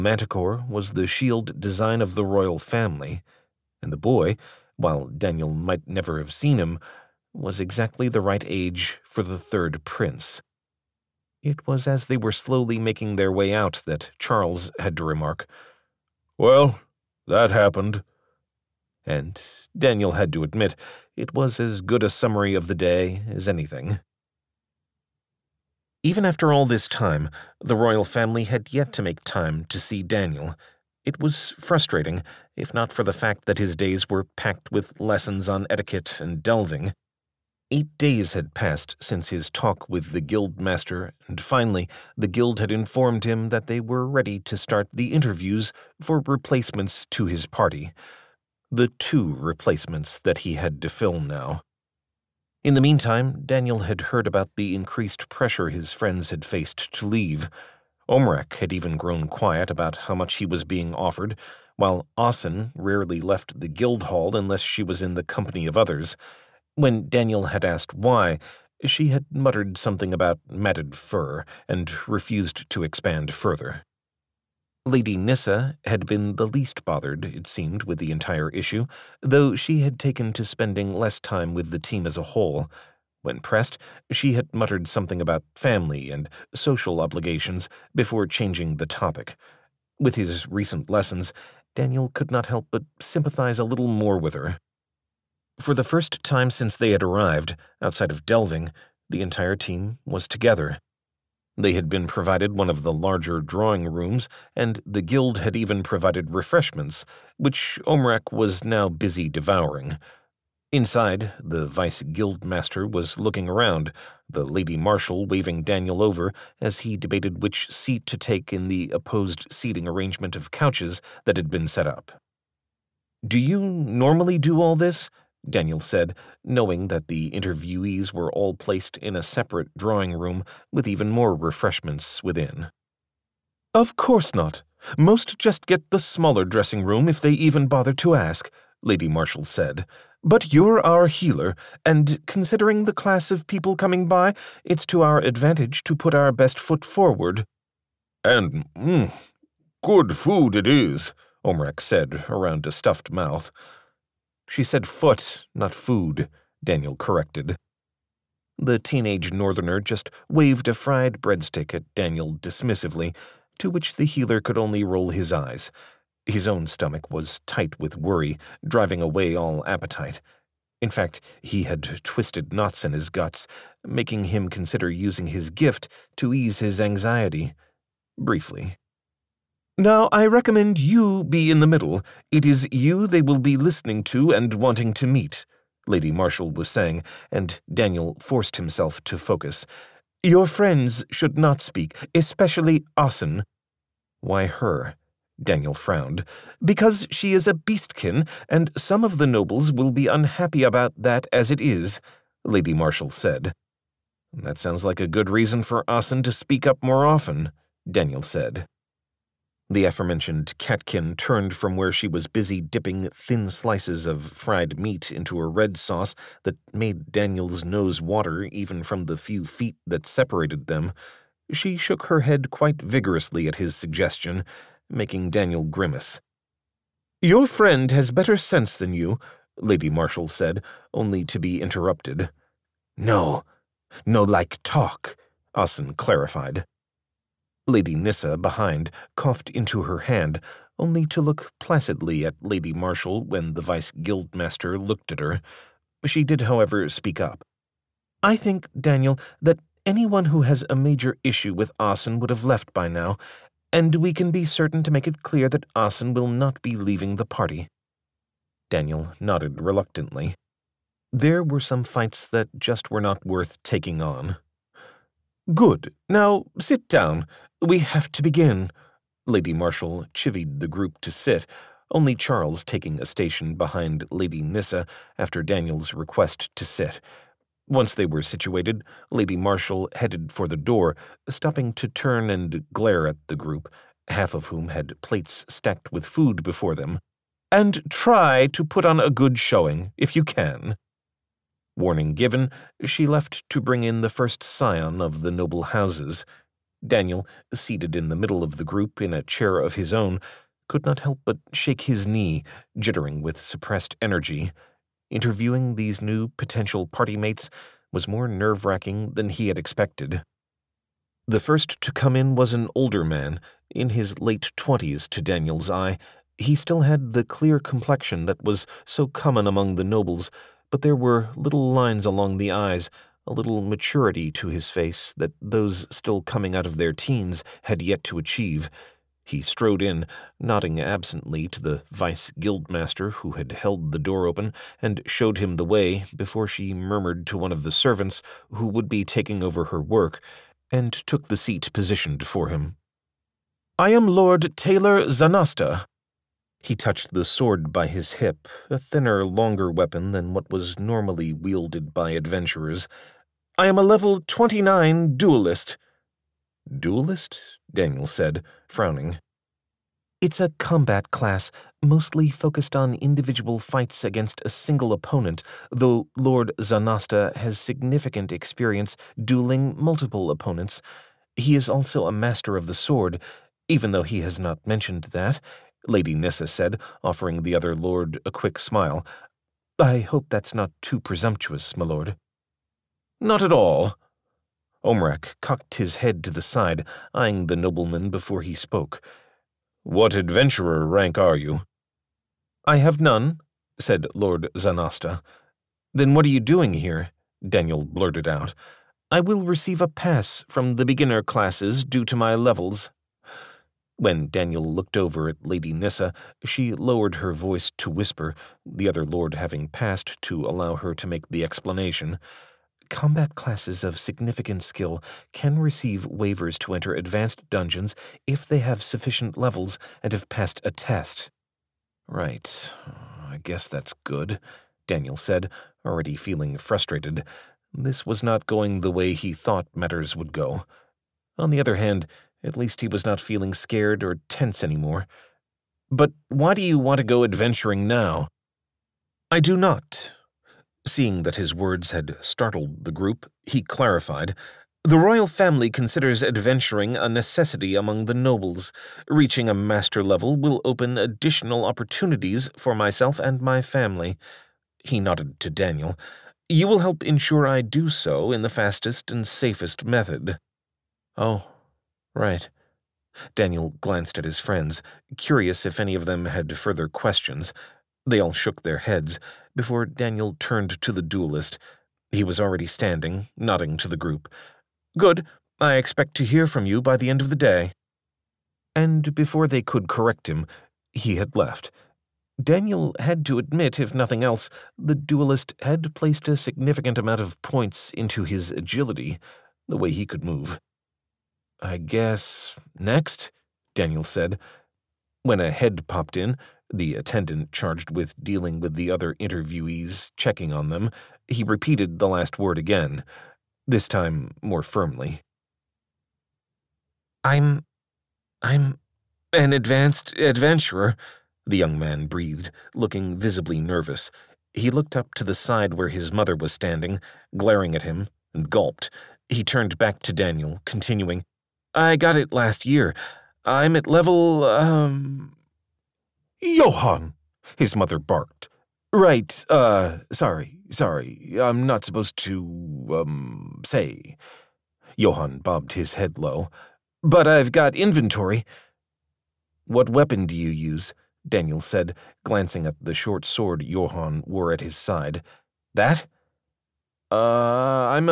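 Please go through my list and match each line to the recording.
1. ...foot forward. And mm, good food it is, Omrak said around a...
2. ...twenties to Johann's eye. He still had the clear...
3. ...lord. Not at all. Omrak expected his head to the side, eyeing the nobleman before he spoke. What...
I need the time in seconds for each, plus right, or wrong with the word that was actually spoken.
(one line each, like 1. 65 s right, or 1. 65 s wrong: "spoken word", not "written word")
1. 146 s right
2. 314 s wrong: "Daniel", not "Johann"
3. 381 s wrong: "cocked", not "expected".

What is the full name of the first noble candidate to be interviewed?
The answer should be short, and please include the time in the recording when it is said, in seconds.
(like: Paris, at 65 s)
Lord Taylor Zanasta, at 344 s.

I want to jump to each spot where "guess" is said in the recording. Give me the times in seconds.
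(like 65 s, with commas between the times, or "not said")
423 s, 491 s.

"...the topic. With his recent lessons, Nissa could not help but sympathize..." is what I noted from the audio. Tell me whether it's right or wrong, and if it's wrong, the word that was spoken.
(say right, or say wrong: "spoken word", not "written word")
wrong: "Daniel", not "Nissa".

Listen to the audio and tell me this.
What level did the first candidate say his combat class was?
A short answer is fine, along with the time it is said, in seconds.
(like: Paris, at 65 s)
29, at 353 s.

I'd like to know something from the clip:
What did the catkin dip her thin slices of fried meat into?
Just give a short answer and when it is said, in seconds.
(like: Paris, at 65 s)
a red sauce, at 215 s.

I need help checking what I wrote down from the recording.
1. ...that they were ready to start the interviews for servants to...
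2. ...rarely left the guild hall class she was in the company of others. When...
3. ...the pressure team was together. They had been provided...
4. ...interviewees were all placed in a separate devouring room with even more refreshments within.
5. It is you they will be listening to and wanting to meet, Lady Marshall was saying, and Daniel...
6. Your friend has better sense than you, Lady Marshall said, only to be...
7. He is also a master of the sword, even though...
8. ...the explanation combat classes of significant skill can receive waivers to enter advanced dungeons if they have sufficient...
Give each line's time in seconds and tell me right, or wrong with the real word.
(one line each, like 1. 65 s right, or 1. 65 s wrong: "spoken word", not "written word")
1. 43 s wrong: "replacements", not "servants"
2. 62 s wrong: "unless", not "class"
3. 99 s wrong: "entire", not "pressure"
4. 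127 s wrong: "drawing", not "devouring"
5. 182 s right
6. 227 s right
7. 371 s right
8. 411 s right.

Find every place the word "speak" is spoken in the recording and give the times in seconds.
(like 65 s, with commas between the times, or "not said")
191 s, 206 s, 246 s.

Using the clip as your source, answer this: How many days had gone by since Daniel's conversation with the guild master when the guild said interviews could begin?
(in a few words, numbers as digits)
8.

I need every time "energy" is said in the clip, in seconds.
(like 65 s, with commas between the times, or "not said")
303 s.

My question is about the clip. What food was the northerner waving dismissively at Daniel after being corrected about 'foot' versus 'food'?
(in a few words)
a fried breadstick.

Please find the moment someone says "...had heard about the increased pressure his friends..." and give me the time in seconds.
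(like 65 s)
53 s.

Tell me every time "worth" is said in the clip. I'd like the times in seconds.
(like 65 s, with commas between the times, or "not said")
263 s.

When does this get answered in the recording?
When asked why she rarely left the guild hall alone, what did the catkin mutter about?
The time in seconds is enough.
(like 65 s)
70 s.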